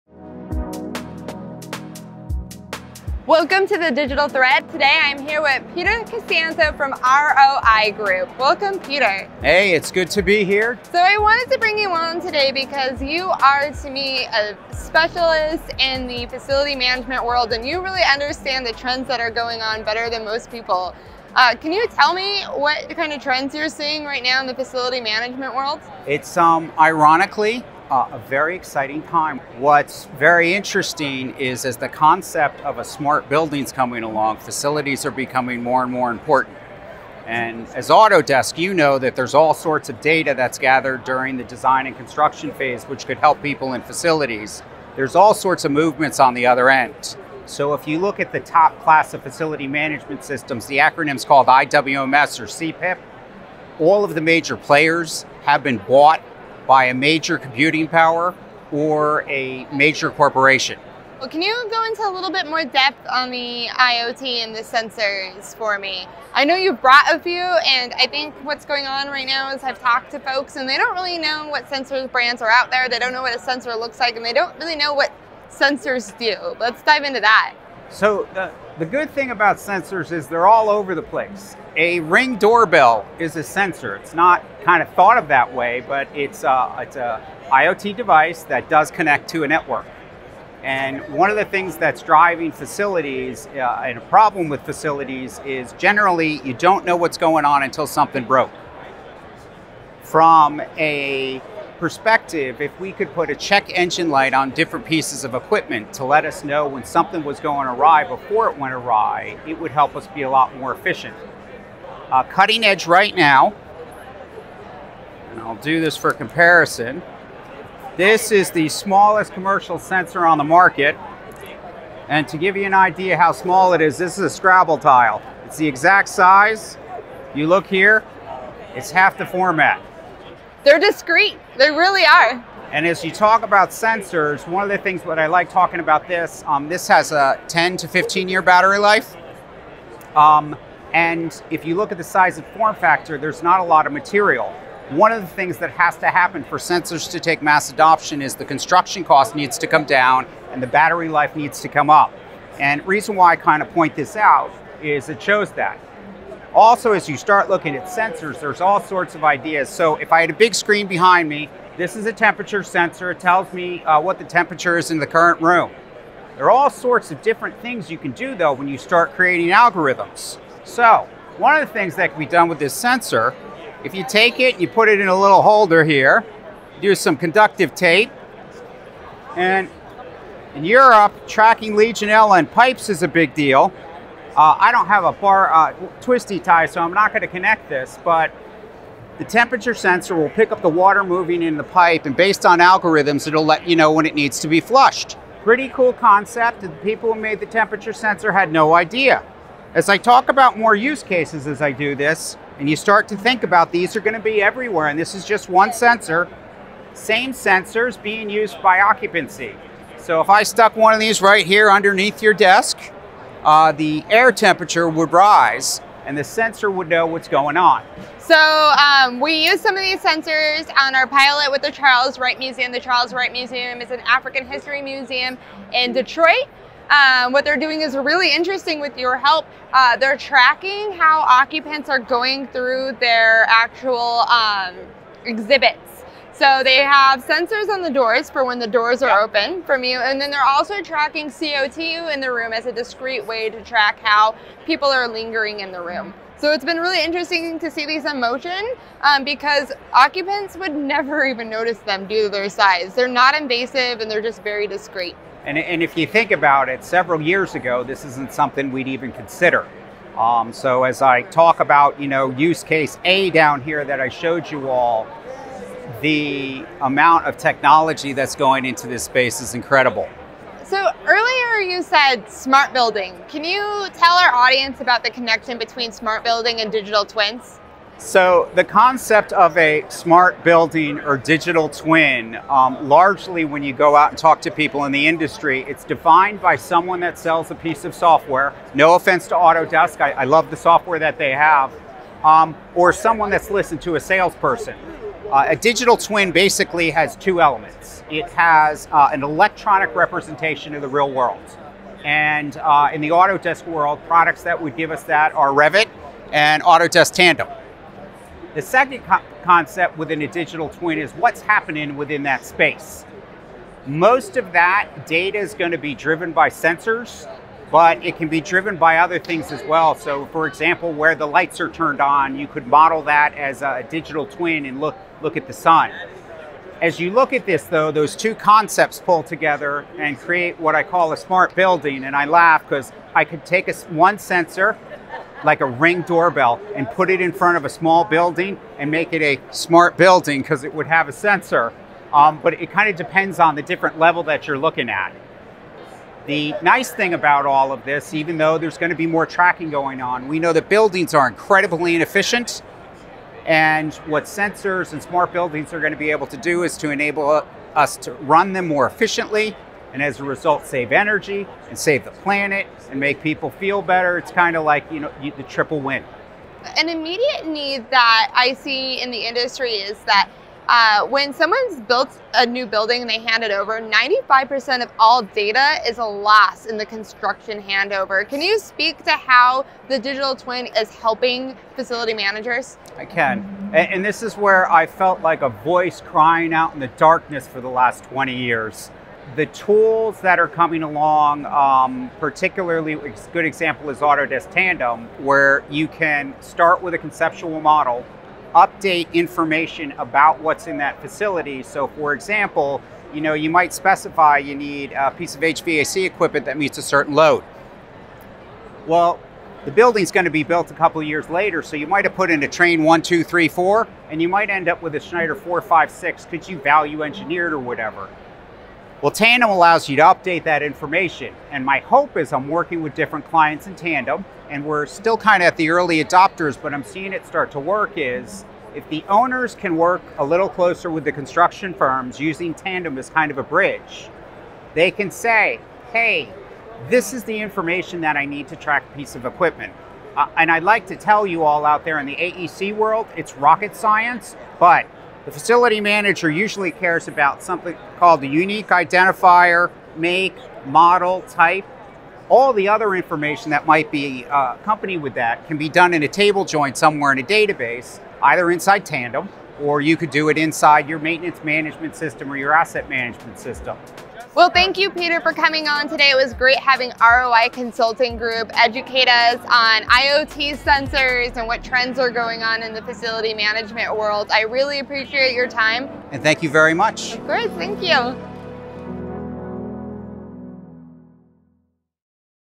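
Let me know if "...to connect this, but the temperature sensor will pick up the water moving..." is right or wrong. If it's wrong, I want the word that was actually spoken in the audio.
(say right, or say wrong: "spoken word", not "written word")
right.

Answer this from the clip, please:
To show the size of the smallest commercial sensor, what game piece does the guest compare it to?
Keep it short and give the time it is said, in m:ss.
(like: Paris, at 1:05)
Scrabble tile, at 2:04.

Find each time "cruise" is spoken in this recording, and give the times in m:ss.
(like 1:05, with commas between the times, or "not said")
not said.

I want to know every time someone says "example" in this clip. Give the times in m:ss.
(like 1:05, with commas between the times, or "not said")
5:20, 6:33, 6:42.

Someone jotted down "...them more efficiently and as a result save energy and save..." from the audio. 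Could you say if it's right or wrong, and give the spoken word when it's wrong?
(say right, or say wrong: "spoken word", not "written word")
right.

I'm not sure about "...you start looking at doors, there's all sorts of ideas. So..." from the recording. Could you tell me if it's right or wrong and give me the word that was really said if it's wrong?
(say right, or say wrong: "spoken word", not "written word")
wrong: "sensors", not "doors".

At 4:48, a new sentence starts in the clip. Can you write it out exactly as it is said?
No offense to Autodesk, I, I love the software that they have, um, or someone that's listened to a salesperson.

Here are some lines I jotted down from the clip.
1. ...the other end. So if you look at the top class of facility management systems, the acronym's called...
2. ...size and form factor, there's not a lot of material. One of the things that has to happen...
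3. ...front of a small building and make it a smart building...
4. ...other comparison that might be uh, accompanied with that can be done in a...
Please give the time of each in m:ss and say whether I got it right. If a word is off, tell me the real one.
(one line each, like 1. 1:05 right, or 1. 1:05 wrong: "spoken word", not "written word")
1. 0:46 right
2. 2:22 right
3. 5:37 right
4. 7:32 wrong: "information", not "comparison".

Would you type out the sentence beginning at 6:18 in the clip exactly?
Can you speak to how the digital twin is helping facility managers?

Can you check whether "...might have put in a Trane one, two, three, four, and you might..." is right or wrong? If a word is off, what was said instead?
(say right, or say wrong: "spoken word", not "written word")
right.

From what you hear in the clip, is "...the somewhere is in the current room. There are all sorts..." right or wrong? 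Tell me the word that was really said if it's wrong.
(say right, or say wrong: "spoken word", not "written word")
wrong: "temperature", not "somewhere".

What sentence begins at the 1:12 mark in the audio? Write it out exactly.
They don't know what a sensor looks like, and they don't really know what sensors do.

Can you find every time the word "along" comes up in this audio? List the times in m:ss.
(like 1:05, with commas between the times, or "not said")
0:34, 6:30.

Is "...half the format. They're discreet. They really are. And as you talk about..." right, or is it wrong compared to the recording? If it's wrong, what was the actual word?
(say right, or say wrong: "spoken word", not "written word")
right.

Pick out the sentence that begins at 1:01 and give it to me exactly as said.
Well, can you go into a little bit more depth on the IoT and the sensors for me?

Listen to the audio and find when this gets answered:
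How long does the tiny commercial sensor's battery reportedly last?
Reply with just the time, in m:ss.
2:17.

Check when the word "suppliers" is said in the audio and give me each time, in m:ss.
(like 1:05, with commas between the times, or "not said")
not said.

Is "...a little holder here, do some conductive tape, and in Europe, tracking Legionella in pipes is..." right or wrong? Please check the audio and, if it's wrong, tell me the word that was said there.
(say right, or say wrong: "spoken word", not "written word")
right.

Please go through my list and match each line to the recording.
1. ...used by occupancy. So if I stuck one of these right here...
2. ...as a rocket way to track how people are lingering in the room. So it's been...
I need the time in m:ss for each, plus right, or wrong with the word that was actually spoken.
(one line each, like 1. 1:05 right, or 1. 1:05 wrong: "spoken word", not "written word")
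1. 3:28 right
2. 4:02 wrong: "discreet", not "rocket".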